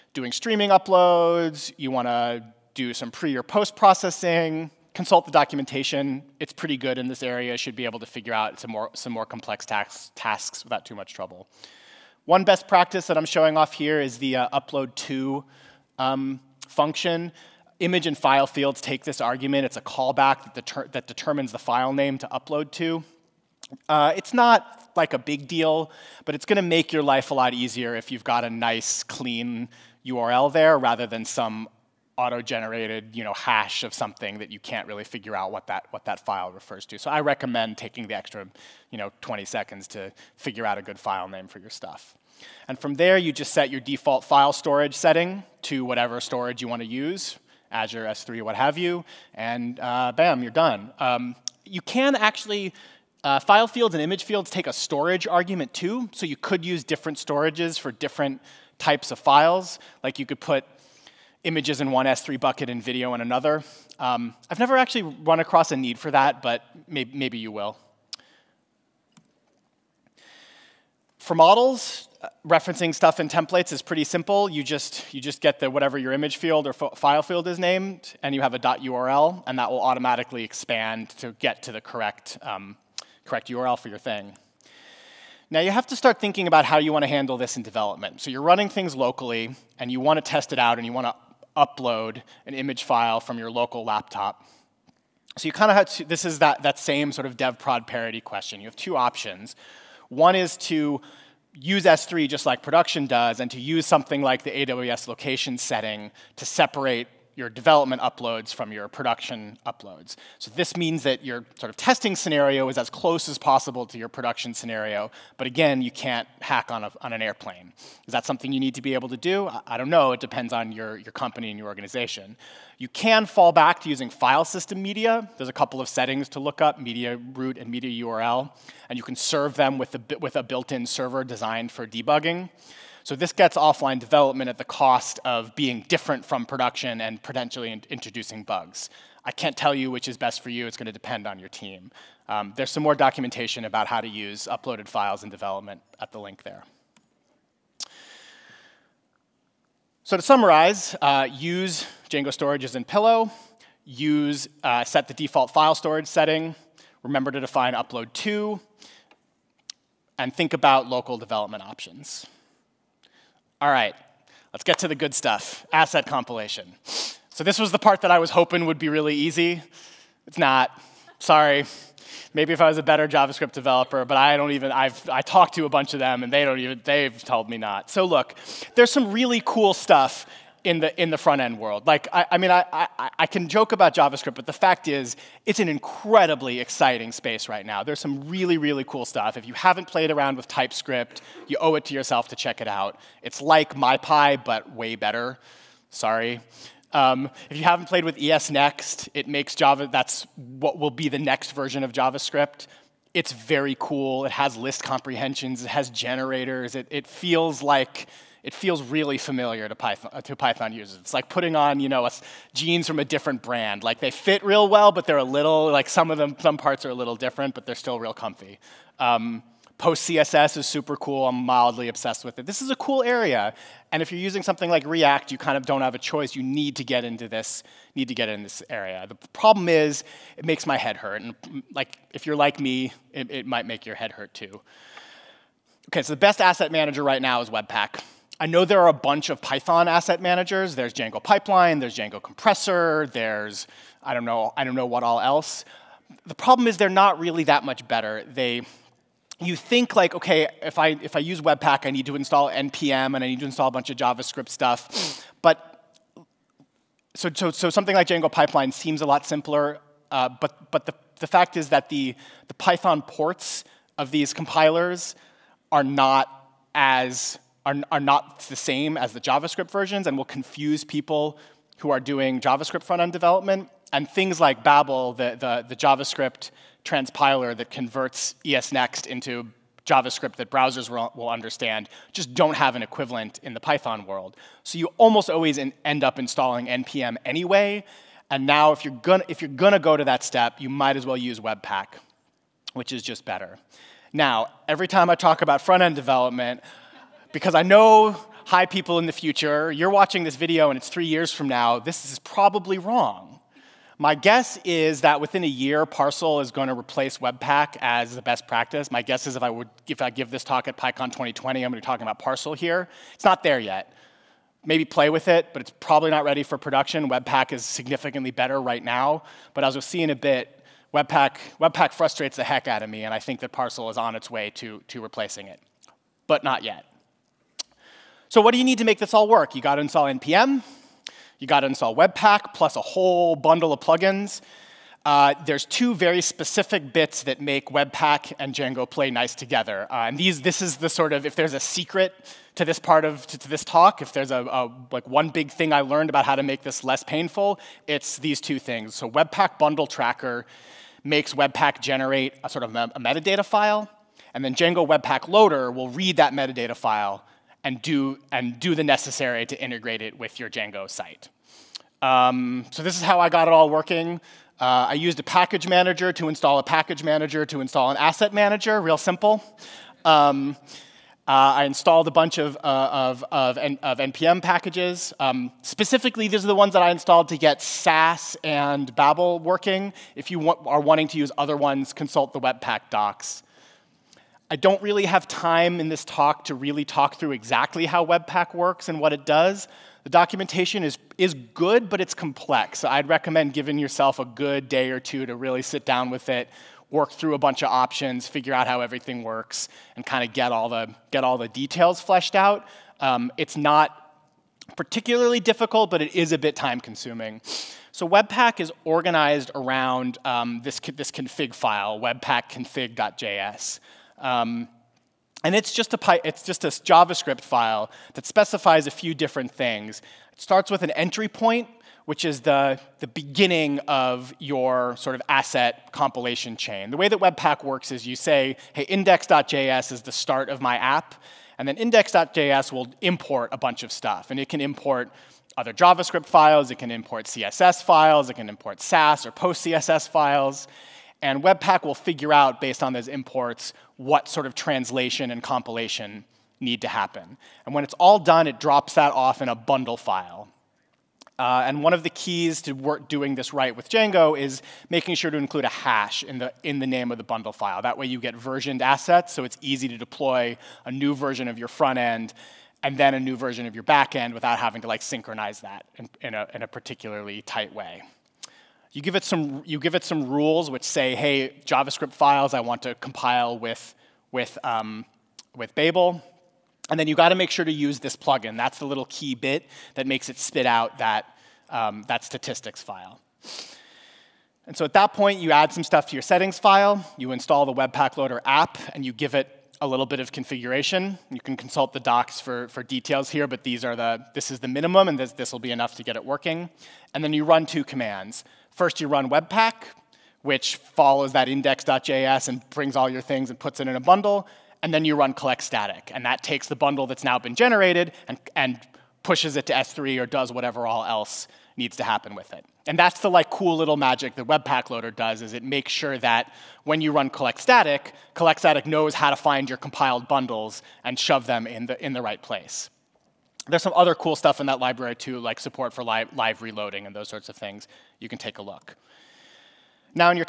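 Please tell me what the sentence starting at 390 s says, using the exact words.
The documentation is, is good, but it's complex.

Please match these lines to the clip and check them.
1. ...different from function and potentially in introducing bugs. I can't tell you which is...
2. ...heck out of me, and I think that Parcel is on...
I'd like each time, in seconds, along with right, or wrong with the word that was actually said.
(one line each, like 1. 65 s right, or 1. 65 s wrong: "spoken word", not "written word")
1. 135 s wrong: "production", not "function"
2. 322 s right.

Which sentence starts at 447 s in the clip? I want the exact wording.
And when it's all done, it drops that off in a bundle file.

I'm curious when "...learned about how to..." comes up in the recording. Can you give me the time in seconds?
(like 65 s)
345 s.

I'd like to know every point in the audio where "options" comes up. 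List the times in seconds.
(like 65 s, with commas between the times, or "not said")
98 s, 161 s, 397 s.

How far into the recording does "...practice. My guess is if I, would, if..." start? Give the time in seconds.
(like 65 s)
308 s.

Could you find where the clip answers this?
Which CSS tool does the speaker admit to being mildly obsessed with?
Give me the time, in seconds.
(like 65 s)
219 s.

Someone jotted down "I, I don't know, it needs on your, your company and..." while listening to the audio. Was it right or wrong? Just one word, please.
wrong.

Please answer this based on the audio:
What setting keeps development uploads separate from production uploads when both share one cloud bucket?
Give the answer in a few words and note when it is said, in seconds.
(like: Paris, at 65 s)
AWS location, at 104 s.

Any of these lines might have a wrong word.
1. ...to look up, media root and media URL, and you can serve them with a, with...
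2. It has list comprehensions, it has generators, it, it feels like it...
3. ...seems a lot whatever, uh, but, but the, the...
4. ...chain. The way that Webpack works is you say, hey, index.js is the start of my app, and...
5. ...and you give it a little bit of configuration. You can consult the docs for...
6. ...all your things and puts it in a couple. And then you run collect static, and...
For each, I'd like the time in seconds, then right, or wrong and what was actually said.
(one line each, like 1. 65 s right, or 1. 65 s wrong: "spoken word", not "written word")
1. 126 s right
2. 204 s right
3. 258 s wrong: "simpler", not "whatever"
4. 426 s right
5. 488 s right
6. 502 s wrong: "bundle", not "couple".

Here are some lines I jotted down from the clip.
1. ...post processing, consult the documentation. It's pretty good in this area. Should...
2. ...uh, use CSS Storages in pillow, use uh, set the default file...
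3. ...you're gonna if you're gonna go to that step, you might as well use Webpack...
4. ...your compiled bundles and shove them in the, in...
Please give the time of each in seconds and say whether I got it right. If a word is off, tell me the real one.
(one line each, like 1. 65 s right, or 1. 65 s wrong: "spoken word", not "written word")
1. 3 s right
2. 151 s wrong: "Django", not "CSS"
3. 288 s right
4. 519 s right.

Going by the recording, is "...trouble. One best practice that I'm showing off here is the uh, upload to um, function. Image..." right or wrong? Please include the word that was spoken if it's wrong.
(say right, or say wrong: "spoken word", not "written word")
right.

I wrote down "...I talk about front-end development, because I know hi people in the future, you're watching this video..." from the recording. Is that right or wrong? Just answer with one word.
right.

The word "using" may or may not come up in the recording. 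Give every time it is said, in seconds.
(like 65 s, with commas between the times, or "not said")
123 s, 224 s.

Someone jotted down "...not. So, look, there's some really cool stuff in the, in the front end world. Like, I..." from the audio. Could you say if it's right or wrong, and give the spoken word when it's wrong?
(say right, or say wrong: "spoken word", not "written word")
right.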